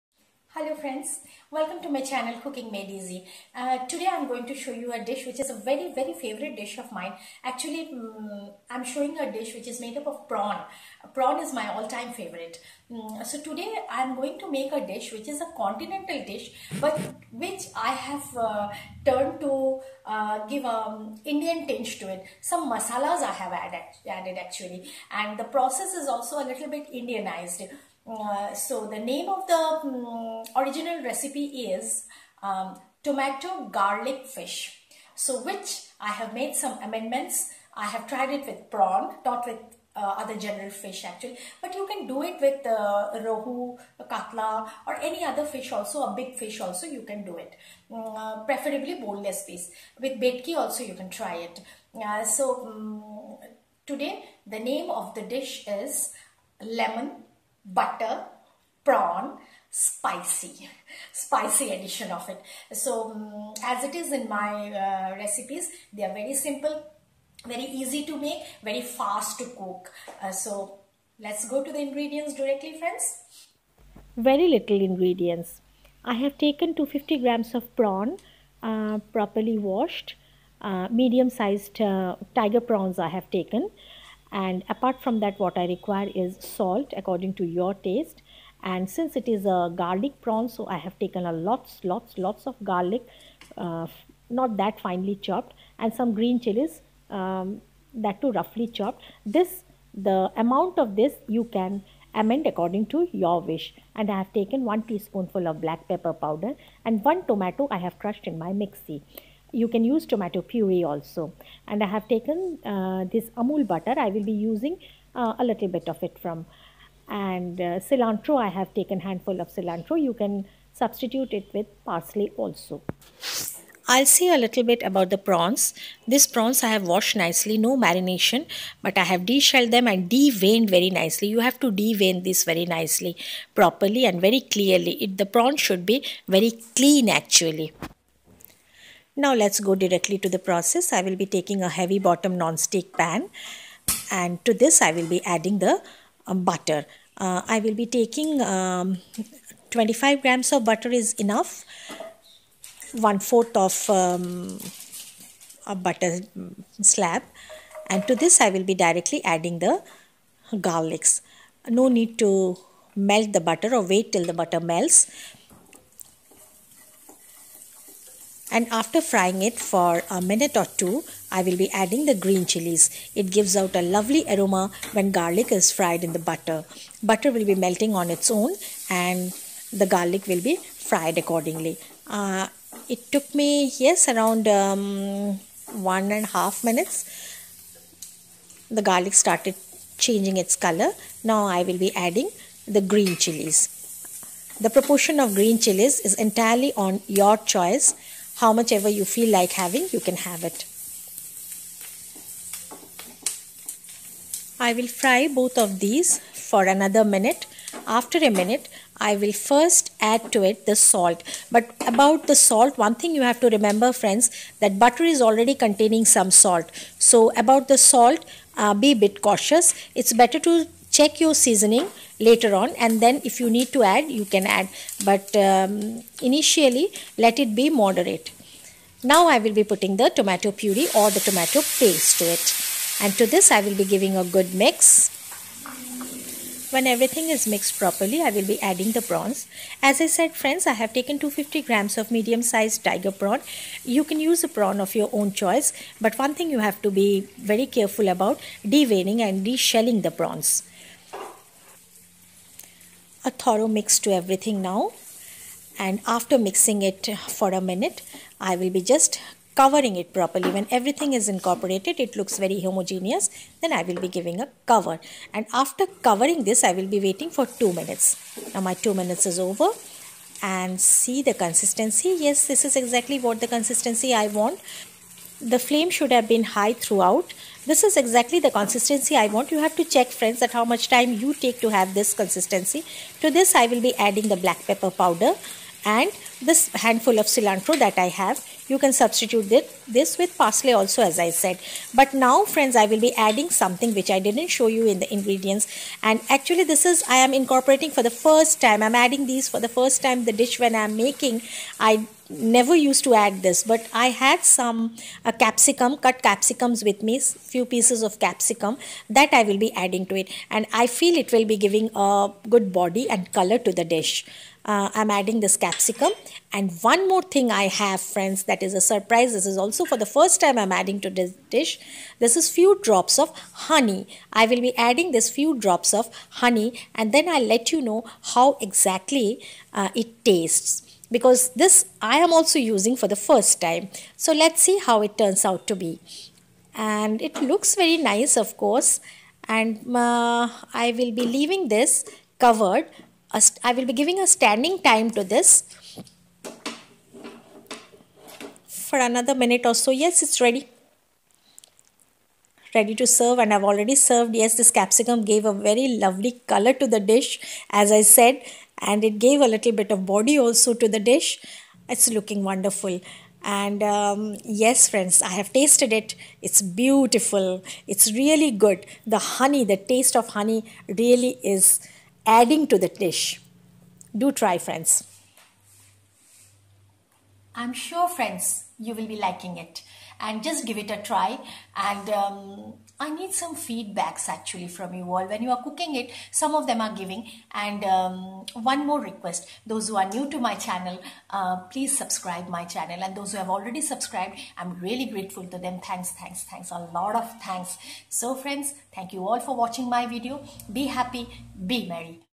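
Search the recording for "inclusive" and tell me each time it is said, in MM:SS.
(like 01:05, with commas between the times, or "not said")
not said.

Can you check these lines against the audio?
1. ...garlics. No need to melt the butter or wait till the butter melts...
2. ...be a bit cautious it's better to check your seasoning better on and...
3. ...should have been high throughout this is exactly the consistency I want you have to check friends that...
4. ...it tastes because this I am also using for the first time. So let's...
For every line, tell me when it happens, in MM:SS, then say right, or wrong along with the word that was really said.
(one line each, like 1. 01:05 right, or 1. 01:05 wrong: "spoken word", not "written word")
1. 02:40 right
2. 03:38 wrong: "later", not "better"
3. 04:35 right
4. 05:29 right.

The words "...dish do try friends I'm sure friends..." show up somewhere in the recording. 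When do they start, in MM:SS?
06:13.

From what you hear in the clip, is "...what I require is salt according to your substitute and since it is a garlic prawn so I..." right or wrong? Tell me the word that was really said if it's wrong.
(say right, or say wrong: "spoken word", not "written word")
wrong: "taste", not "substitute".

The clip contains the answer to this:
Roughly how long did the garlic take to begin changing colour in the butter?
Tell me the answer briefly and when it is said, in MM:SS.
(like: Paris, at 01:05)
one and a half minutes, at 03:05.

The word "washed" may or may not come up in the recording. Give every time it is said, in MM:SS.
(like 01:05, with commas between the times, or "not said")
01:19, 02:06.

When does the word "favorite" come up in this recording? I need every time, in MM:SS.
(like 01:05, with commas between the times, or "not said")
00:06, 00:12.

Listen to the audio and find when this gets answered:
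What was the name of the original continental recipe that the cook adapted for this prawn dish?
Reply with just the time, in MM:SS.
00:33.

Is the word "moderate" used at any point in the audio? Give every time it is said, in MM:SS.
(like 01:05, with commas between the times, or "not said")
03:47.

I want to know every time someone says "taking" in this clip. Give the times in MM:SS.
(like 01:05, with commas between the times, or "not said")
02:21, 02:27.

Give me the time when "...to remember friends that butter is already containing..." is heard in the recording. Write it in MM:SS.
03:33.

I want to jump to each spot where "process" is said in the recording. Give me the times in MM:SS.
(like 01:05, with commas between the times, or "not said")
00:25, 02:20.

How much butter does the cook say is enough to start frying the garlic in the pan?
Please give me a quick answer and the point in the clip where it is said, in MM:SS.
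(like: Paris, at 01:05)
25 grams, at 02:29.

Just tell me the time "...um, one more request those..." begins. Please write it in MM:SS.
06:27.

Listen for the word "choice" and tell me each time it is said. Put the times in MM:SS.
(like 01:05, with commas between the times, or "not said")
03:17, 04:05.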